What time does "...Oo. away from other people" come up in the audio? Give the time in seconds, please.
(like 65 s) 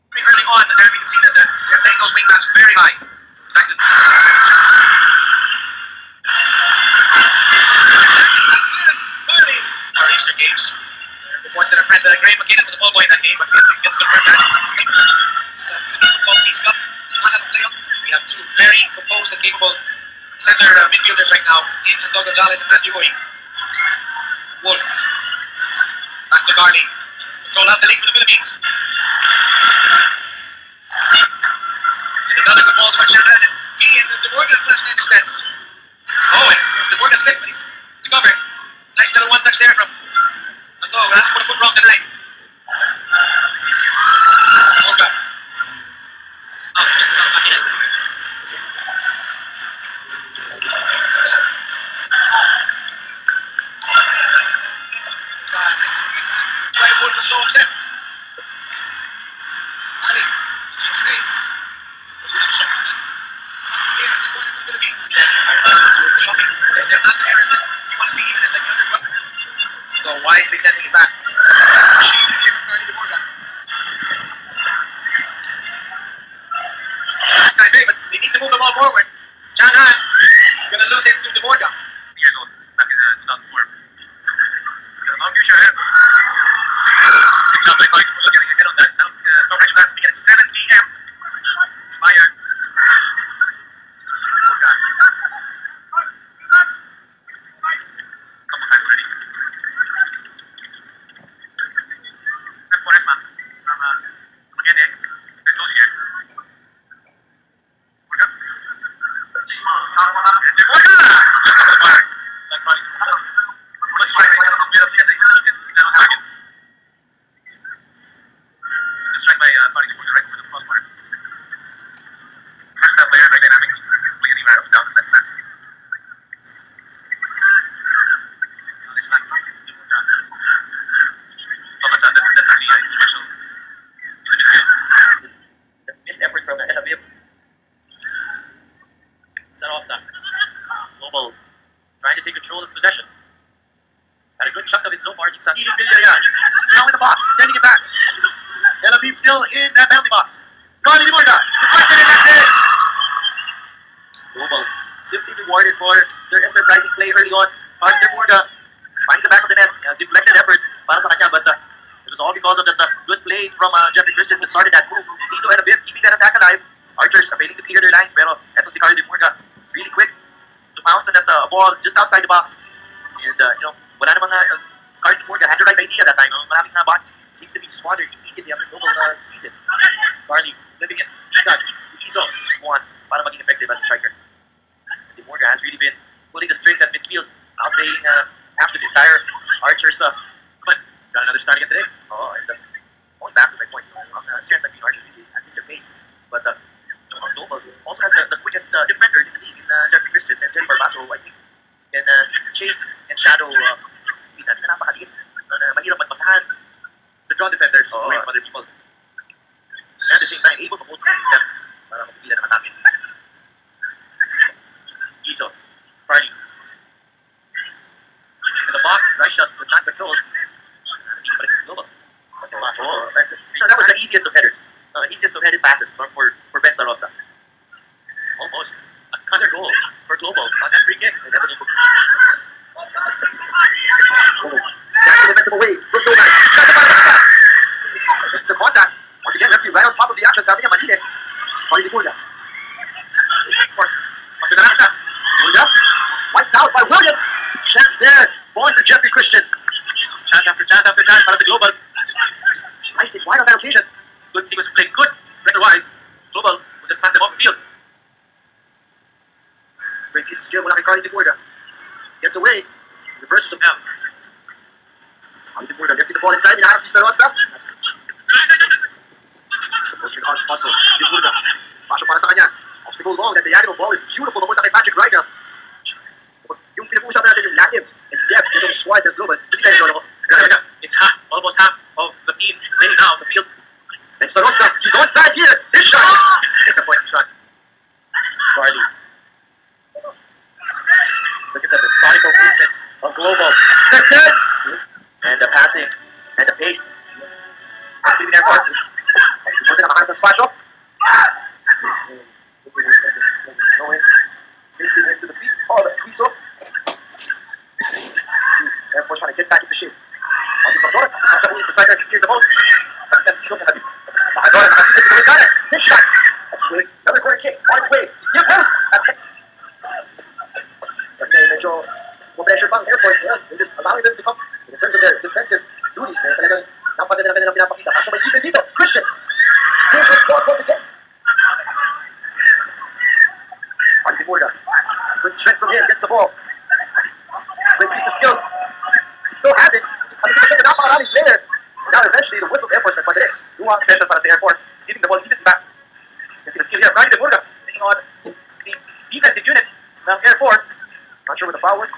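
207 s.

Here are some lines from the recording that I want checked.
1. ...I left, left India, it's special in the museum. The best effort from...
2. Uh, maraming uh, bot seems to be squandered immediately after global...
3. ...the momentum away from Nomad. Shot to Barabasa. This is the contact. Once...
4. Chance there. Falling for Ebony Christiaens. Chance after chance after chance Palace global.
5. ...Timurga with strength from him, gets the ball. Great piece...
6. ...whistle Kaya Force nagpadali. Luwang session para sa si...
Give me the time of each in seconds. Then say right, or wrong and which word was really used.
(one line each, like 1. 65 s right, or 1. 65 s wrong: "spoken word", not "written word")
1. 132 s right
2. 176 s right
3. 235 s right
4. 247 s wrong: "Jeffrey", not "Ebony"
5. 334 s right
6. 342 s wrong: "Air", not "Kaya".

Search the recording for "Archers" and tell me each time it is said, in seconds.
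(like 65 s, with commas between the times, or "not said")
166 s, 189 s, 194 s.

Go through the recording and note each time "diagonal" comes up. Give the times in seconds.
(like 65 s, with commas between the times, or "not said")
273 s.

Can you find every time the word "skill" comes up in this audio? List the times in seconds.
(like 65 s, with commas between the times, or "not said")
260 s, 338 s, 346 s.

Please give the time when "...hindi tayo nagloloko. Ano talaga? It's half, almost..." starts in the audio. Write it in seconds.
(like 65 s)
279 s.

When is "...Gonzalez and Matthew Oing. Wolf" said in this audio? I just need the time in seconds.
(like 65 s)
22 s.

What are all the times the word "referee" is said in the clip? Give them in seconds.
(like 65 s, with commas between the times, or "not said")
239 s.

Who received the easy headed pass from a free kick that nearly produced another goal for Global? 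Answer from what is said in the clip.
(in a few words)
Ben Starosta.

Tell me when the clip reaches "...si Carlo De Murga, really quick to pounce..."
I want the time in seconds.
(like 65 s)
168 s.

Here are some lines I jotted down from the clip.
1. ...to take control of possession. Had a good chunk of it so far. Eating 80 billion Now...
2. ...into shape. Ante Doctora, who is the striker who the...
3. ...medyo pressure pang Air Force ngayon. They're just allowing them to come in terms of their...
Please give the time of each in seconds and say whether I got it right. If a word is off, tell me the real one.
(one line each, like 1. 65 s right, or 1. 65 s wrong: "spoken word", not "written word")
1. 142 s right
2. 309 s right
3. 321 s right.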